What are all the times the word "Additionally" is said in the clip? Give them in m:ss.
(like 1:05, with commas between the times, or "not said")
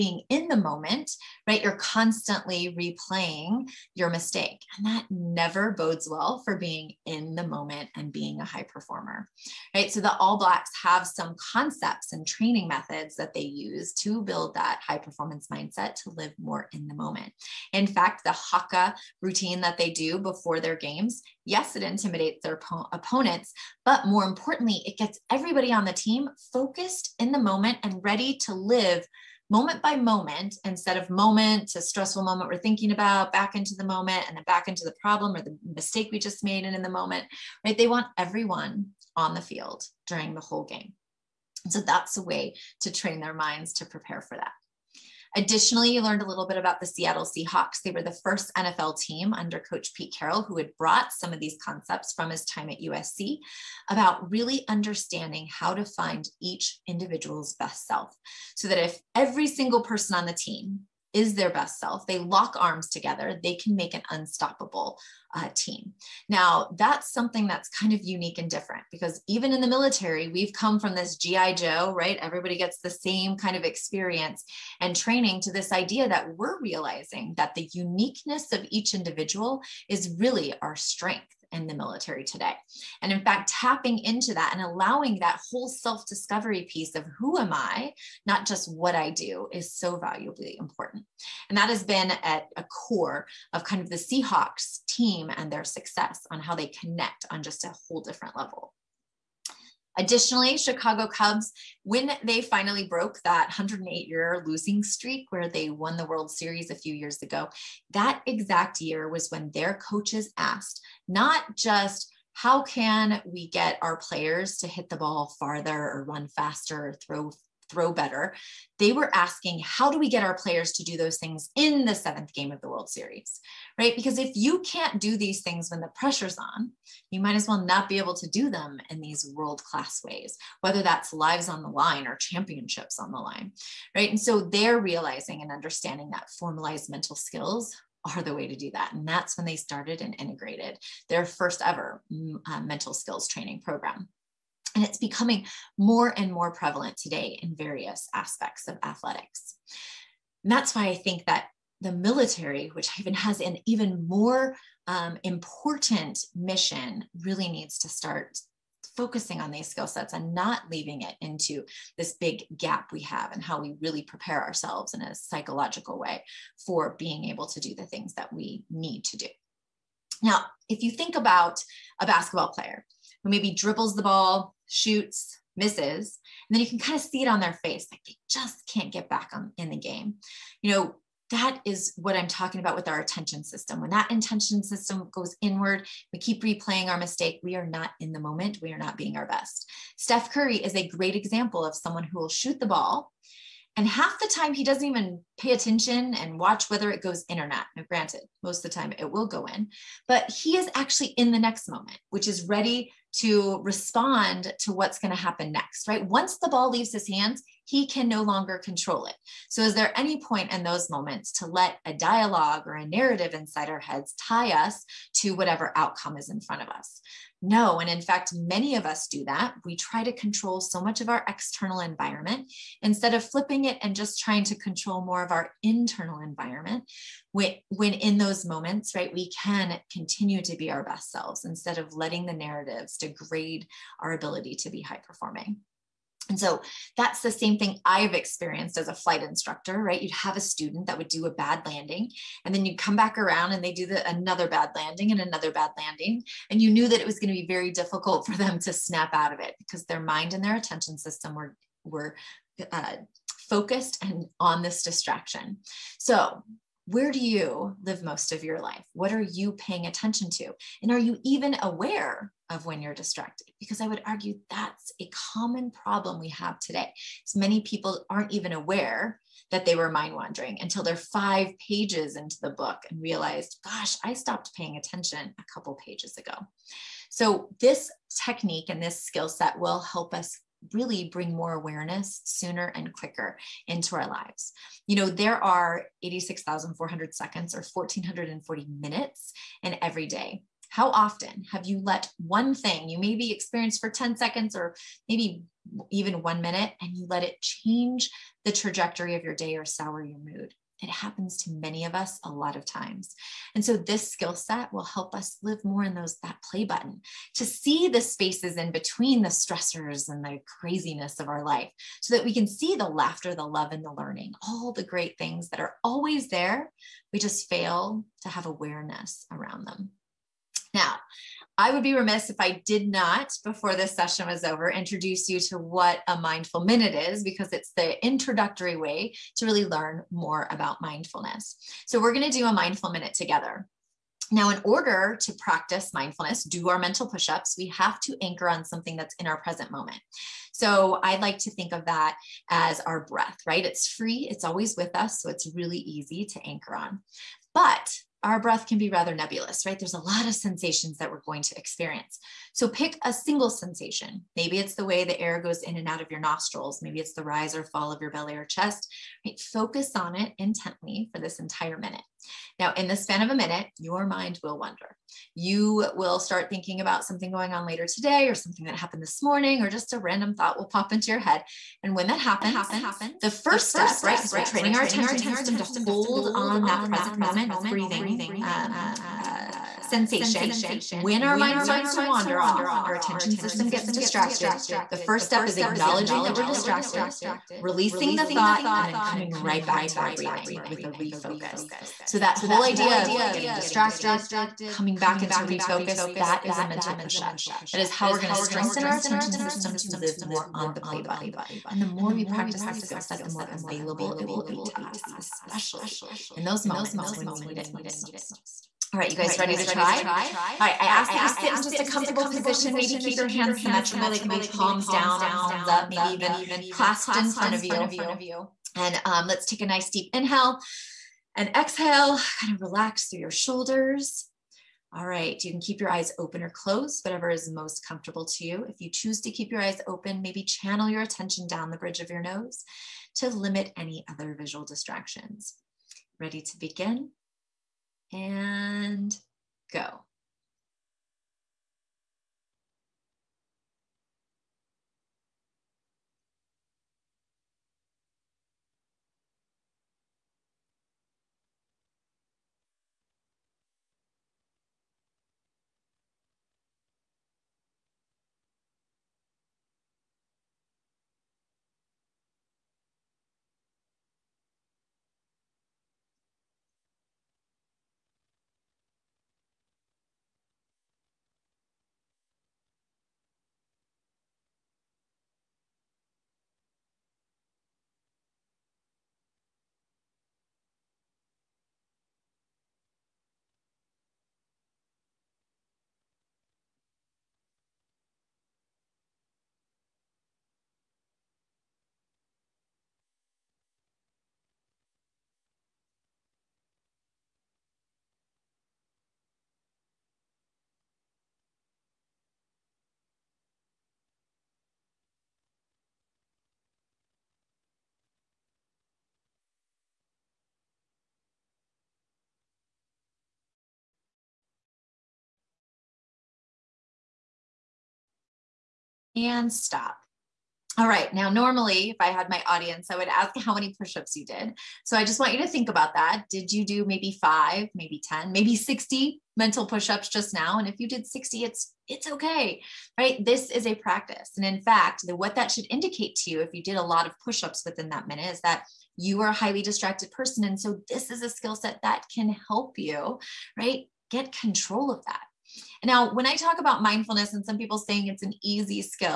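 0:45, 1:39.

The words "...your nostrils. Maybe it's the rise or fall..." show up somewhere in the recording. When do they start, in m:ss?
5:56.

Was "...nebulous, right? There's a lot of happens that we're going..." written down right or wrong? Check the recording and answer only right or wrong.
wrong.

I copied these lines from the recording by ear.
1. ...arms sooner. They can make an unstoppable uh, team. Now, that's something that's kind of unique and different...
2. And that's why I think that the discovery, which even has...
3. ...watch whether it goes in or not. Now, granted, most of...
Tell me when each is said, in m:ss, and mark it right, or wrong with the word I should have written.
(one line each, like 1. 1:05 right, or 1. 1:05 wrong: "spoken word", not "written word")
1. 1:02 wrong: "together", not "sooner"
2. 2:30 wrong: "military", not "discovery"
3. 3:16 right.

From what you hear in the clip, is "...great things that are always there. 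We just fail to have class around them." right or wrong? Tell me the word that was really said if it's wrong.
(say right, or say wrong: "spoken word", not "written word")
wrong: "awareness", not "class".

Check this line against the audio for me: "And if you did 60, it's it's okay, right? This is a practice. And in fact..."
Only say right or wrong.
right.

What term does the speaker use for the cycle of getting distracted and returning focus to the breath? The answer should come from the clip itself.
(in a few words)
mental push up.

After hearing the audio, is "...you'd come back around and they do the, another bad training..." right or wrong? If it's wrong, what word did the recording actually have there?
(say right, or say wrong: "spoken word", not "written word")
wrong: "landing", not "training".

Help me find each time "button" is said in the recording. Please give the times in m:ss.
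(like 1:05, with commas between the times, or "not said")
5:06, 6:41.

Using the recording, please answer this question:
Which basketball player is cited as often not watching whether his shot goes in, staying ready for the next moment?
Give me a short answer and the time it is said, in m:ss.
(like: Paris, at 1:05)
Steph Curry, at 3:09.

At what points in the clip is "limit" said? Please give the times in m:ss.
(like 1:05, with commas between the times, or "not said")
7:13.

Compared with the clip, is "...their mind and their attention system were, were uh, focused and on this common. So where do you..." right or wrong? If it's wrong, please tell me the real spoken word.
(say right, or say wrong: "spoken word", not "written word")
wrong: "distraction", not "common".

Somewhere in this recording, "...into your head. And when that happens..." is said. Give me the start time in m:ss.
6:10.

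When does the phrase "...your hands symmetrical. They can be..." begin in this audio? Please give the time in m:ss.
6:53.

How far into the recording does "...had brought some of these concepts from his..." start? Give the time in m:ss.
0:50.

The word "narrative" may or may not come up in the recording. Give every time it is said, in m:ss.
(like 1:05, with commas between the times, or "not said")
3:32, 3:52.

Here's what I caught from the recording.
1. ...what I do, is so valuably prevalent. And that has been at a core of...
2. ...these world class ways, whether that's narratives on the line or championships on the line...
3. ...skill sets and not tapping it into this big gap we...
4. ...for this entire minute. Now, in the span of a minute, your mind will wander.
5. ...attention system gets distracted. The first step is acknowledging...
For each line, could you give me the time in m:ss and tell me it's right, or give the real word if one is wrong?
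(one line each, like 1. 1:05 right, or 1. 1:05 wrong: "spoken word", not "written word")
1. 1:28 wrong: "important", not "prevalent"
2. 2:08 wrong: "lives", not "narratives"
3. 2:39 wrong: "leaving", not "tapping"
4. 6:01 right
5. 6:22 right.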